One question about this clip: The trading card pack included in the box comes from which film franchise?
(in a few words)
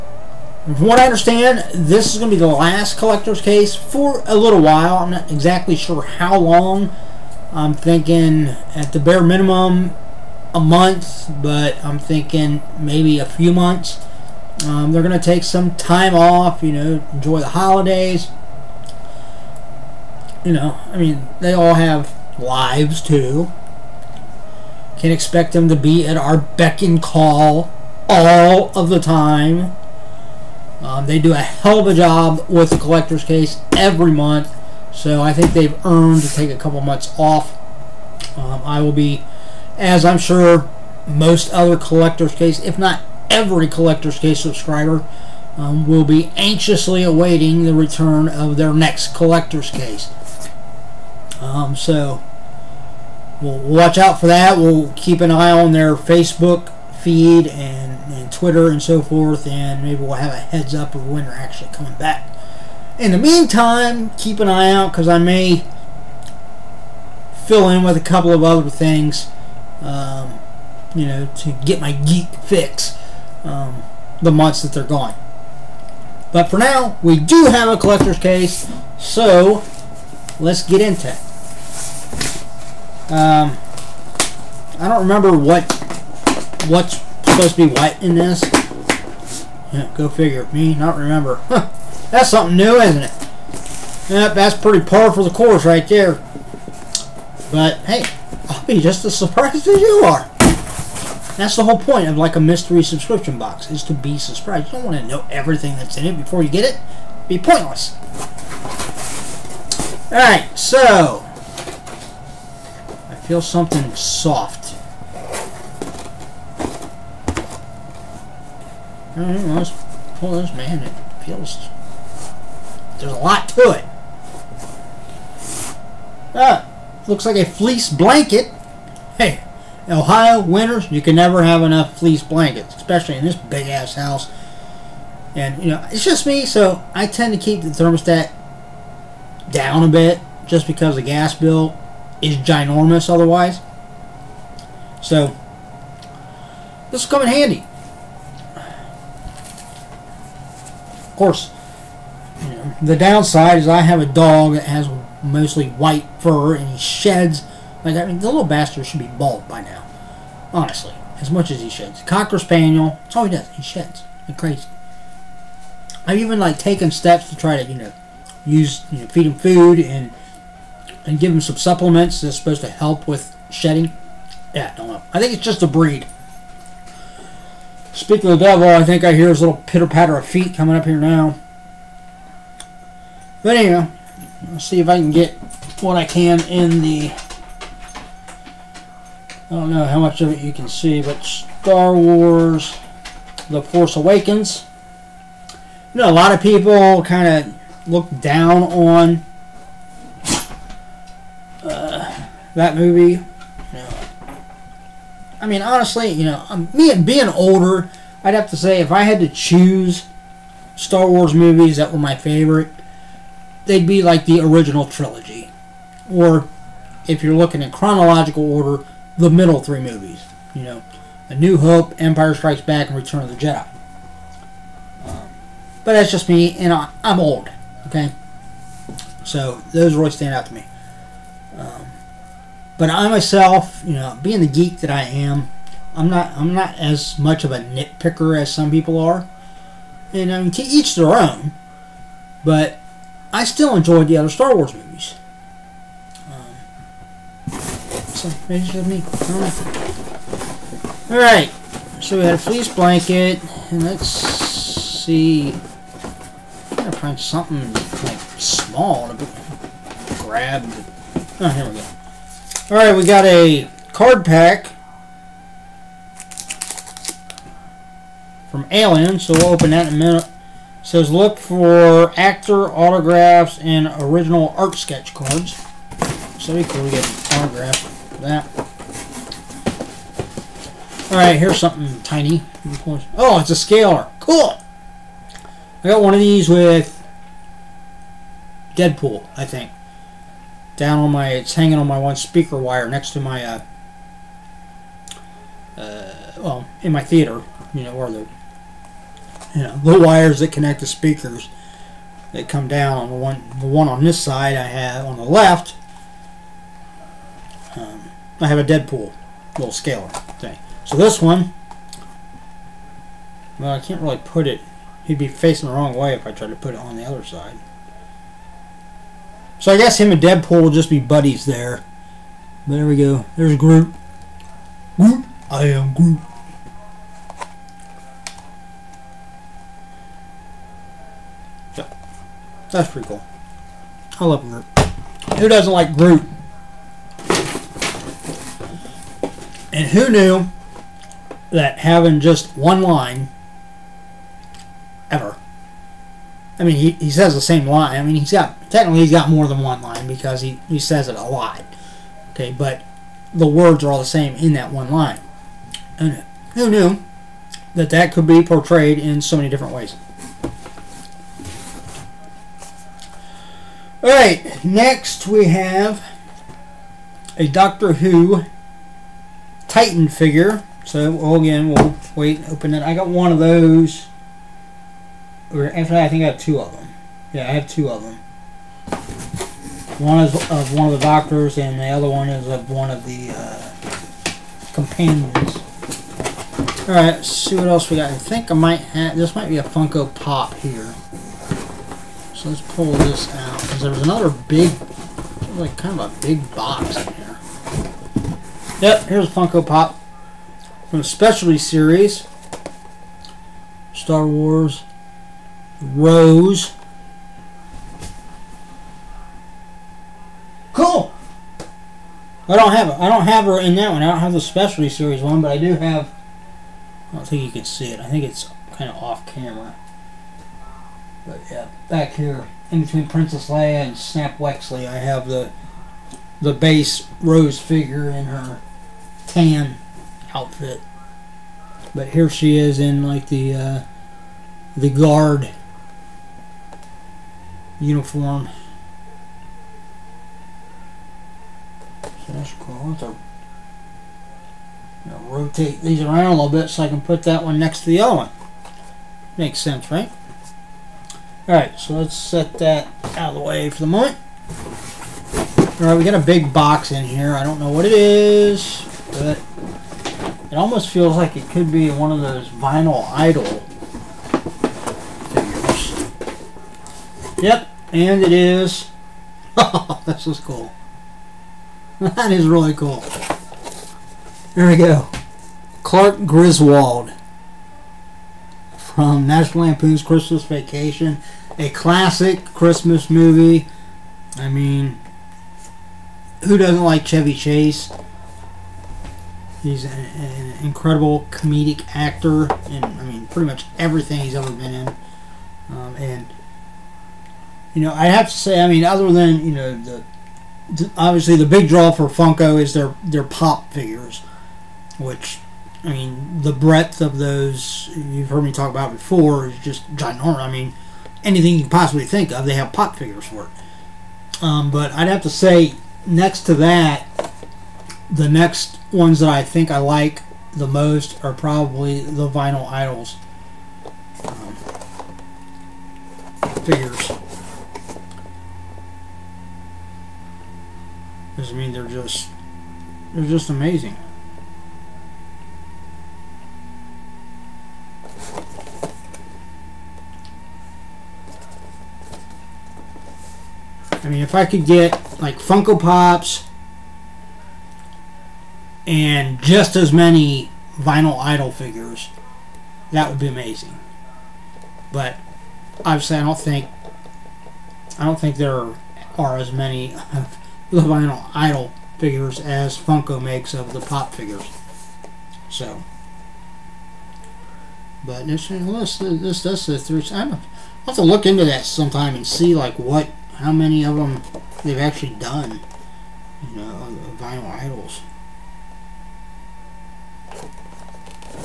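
Alien.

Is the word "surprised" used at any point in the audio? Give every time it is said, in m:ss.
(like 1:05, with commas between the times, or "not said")
1:39, 1:44.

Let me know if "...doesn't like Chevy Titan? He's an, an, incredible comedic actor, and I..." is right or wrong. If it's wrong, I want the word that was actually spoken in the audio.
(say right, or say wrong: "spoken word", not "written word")
wrong: "Chase", not "Titan".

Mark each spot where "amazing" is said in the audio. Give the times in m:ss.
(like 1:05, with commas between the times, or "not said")
8:53, 9:13.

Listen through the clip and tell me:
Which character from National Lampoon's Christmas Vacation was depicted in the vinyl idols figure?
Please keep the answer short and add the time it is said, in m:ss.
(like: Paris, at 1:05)
Clark Griswold, at 7:55.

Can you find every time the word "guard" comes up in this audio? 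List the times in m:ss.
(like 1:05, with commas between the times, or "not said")
7:14.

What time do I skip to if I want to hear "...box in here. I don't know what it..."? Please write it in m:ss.
7:36.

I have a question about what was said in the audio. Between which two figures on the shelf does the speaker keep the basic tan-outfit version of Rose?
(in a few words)
Princess Leia and Snap Wexley.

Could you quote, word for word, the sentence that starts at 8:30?
I mean, anything you can possibly think of, they have pop figures for it.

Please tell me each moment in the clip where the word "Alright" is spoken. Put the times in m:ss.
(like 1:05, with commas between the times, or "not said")
1:50, 4:11, 4:22, 4:41, 6:04, 7:31, 7:35.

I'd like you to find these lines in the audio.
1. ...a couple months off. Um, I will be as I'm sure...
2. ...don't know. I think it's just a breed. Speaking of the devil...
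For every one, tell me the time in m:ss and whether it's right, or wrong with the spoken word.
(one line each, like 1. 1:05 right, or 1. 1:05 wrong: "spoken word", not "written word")
1. 0:36 right
2. 2:54 right.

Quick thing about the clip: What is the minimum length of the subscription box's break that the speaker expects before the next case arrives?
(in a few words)
a month.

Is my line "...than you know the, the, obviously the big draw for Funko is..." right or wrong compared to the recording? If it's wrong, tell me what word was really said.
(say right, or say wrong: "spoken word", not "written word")
right.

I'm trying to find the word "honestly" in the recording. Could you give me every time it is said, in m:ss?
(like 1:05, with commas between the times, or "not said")
2:40, 3:25.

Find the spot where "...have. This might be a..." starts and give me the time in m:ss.
6:28.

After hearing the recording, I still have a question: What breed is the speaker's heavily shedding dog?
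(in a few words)
Cocker Spaniel.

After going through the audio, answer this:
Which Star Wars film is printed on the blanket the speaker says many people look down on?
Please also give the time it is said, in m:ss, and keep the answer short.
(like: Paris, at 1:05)
The Force Awakens, at 3:11.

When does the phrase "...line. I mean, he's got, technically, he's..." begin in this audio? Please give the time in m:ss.
5:47.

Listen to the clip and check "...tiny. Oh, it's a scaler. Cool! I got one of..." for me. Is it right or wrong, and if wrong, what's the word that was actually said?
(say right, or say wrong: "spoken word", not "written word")
right.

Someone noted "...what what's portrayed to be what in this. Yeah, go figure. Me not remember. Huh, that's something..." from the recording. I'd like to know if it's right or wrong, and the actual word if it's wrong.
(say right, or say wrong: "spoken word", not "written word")
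wrong: "supposed", not "portrayed".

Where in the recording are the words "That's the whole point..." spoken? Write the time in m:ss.
1:41.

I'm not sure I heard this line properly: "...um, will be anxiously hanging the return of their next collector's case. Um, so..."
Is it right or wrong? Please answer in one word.
wrong.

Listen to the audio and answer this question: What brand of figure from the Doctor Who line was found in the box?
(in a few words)
Titan.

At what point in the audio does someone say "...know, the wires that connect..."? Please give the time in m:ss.
4:59.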